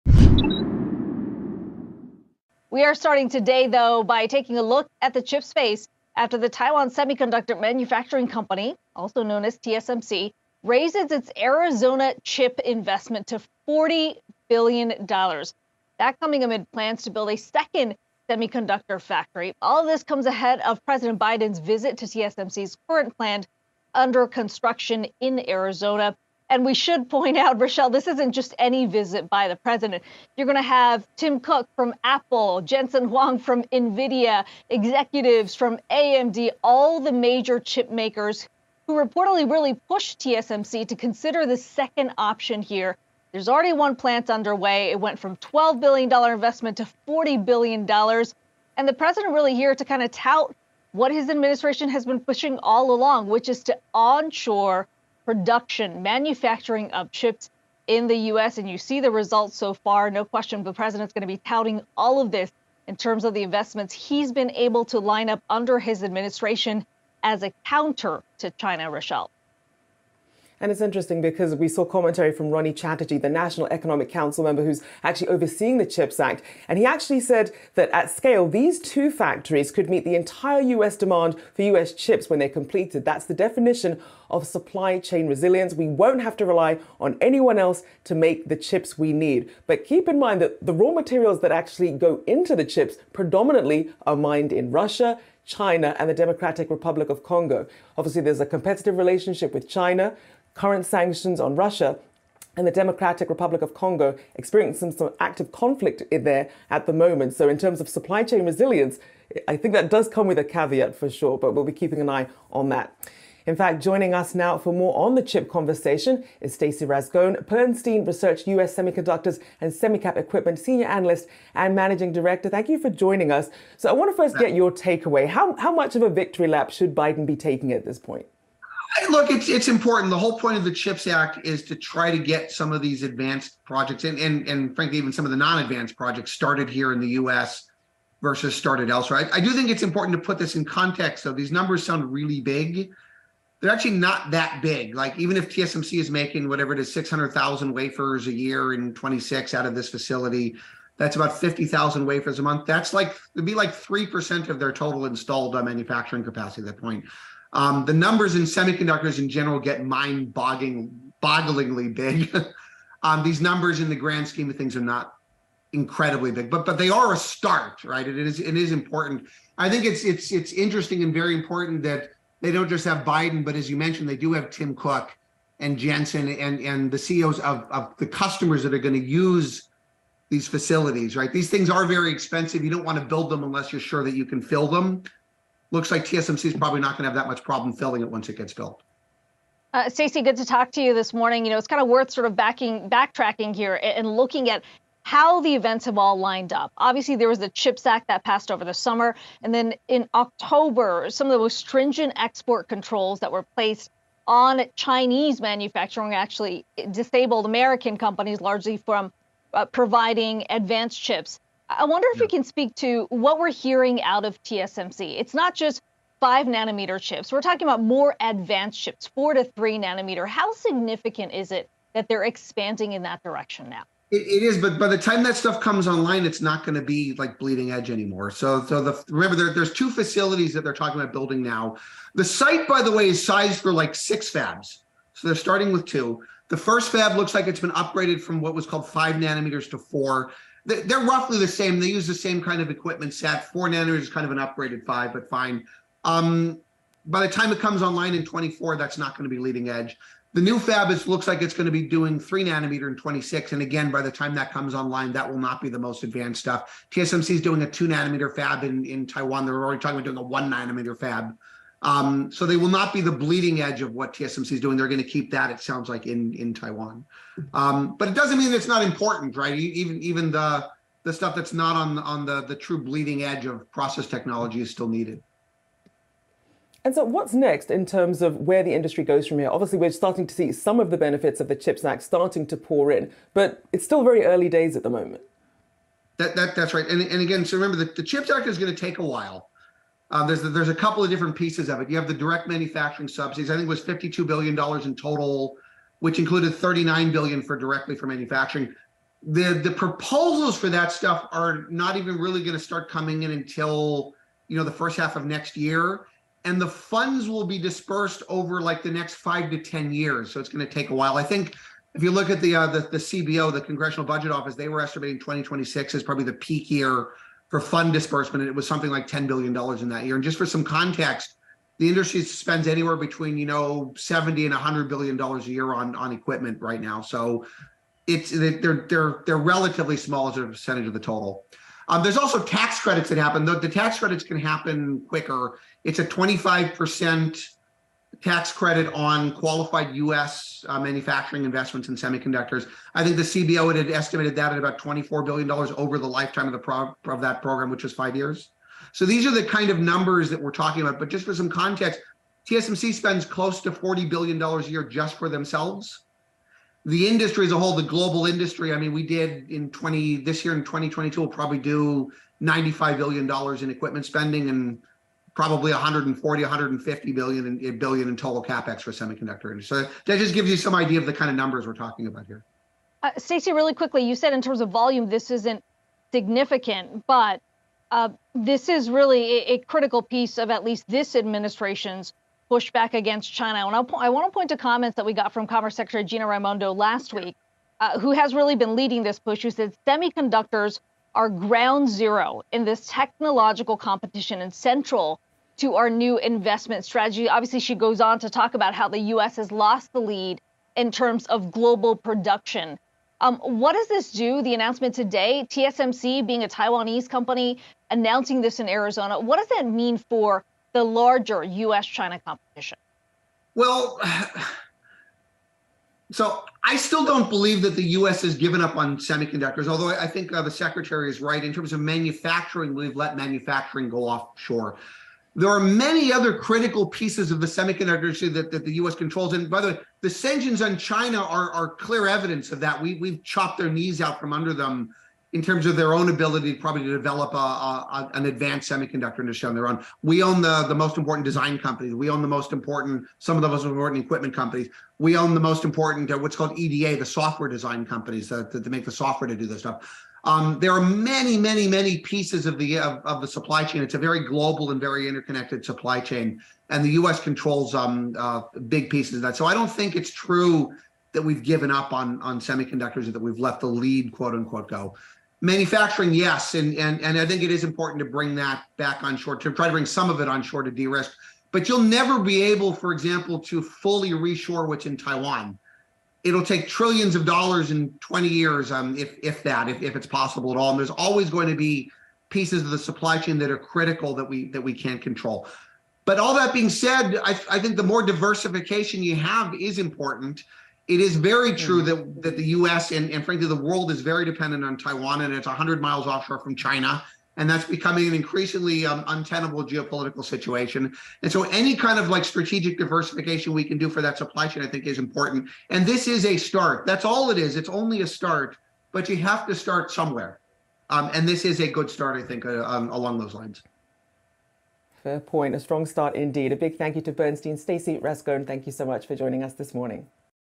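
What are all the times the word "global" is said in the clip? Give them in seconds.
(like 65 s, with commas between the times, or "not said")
357 s, 401 s, 454 s.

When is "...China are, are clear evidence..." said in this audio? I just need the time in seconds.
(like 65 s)
430 s.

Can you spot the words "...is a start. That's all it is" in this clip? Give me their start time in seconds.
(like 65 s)
506 s.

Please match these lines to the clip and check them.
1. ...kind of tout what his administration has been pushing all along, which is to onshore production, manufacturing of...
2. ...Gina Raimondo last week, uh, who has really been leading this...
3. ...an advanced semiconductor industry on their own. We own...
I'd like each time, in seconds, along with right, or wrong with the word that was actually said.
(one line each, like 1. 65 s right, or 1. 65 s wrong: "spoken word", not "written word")
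1. 49 s right
2. 386 s right
3. 438 s right.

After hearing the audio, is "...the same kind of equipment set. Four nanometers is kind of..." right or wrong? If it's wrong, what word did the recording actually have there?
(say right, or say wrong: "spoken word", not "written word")
right.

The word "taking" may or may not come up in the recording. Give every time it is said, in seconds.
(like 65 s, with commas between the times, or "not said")
4 s, 127 s.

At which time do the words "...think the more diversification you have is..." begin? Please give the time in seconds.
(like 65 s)
487 s.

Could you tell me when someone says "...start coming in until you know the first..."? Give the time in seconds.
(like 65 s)
302 s.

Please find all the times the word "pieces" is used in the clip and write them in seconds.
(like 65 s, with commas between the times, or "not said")
291 s, 380 s, 426 s, 451 s, 458 s, 482 s.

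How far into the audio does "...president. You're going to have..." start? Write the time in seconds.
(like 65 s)
29 s.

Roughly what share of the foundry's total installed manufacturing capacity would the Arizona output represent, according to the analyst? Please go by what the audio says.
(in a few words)
3%.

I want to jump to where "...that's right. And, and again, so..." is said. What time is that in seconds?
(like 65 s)
286 s.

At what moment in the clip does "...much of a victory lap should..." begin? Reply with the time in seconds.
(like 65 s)
125 s.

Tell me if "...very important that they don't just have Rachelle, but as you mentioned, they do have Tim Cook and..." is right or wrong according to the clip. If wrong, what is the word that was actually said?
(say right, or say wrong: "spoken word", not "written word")
wrong: "Biden", not "Rachelle".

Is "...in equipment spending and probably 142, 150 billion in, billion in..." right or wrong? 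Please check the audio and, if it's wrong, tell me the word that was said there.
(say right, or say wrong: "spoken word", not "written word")
wrong: "140", not "142".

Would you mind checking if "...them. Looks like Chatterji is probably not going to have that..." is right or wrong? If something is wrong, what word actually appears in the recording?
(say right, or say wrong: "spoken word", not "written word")
wrong: "TSMC", not "Chatterji".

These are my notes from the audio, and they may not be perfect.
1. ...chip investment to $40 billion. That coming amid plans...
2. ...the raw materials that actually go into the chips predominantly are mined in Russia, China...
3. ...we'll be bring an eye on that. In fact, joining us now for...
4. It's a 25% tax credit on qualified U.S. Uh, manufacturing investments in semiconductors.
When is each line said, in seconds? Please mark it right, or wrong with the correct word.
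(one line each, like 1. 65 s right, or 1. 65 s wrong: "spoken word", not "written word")
1. 12 s right
2. 90 s right
3. 111 s wrong: "keeping", not "bring"
4. 335 s right.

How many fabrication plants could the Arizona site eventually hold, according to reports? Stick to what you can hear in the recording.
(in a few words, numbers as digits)
6.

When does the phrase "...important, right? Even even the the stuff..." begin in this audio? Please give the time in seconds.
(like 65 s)
268 s.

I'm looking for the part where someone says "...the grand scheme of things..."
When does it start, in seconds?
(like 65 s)
163 s.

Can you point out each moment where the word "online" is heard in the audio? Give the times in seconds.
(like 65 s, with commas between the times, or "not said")
225 s, 247 s, 254 s.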